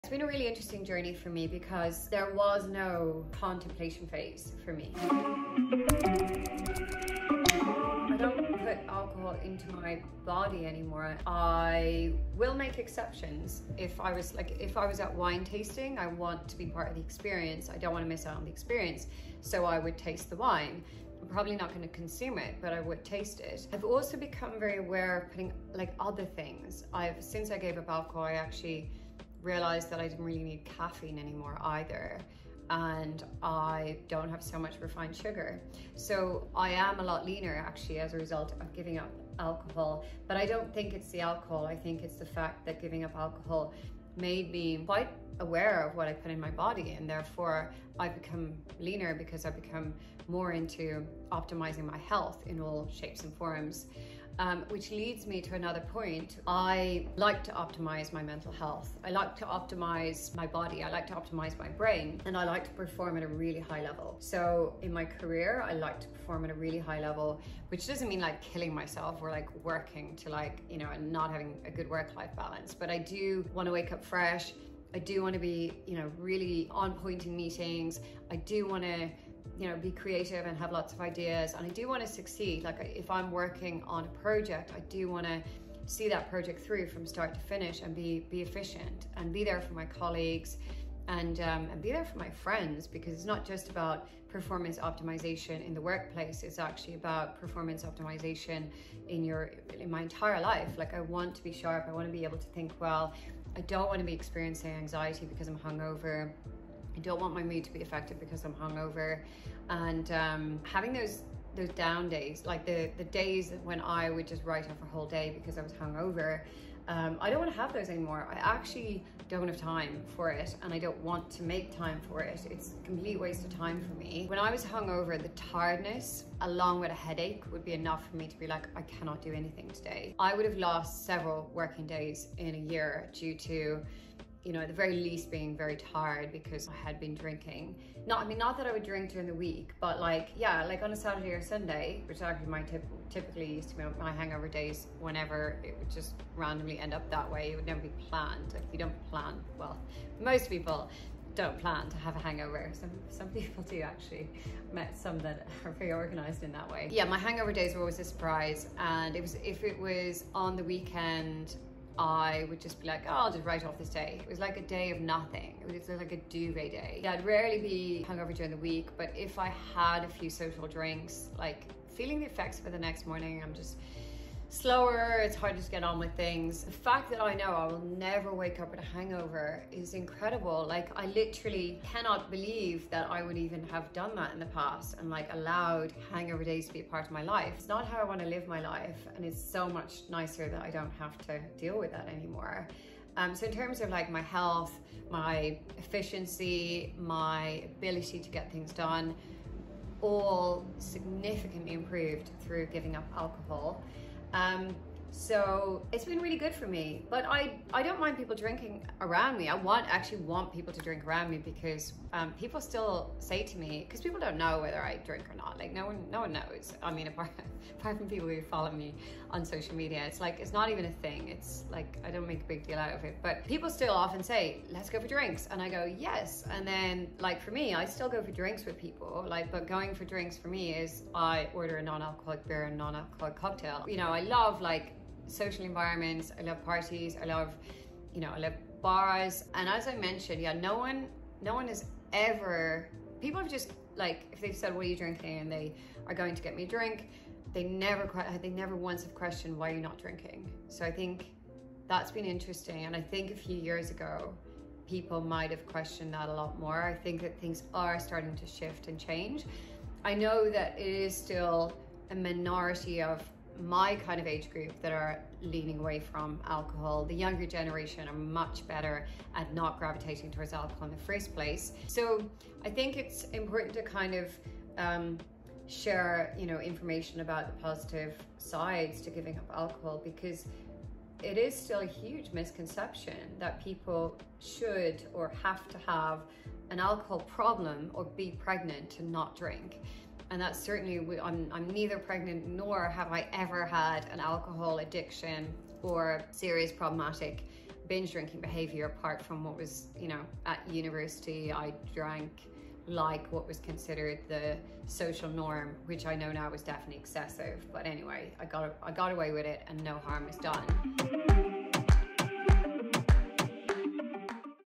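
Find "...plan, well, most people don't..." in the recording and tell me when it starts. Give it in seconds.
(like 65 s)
149 s.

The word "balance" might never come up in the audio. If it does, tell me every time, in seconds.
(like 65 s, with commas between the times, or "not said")
72 s.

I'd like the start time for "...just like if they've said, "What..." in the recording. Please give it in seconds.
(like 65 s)
243 s.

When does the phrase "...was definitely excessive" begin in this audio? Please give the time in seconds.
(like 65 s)
306 s.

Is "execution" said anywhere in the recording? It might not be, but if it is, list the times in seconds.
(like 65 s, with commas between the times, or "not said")
not said.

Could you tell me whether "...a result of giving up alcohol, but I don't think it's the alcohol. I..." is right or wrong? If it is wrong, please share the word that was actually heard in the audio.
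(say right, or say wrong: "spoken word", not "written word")
right.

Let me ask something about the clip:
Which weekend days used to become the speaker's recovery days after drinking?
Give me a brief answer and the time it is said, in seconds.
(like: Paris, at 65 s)
Saturday or Sunday, at 140 s.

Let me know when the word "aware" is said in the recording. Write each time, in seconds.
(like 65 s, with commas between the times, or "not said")
24 s, 45 s.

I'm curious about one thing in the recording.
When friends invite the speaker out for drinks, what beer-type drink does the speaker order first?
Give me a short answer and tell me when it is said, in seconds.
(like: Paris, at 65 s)
Non-alcoholic beer, at 231 s.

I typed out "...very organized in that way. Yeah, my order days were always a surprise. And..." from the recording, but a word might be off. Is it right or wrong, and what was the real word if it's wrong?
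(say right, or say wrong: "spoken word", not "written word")
wrong: "hangover", not "order".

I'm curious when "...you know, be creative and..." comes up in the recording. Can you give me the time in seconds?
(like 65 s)
79 s.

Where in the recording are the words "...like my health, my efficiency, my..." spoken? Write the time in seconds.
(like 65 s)
193 s.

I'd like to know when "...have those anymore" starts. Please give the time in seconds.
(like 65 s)
117 s.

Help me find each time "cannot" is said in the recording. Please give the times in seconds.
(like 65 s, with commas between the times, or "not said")
128 s, 181 s.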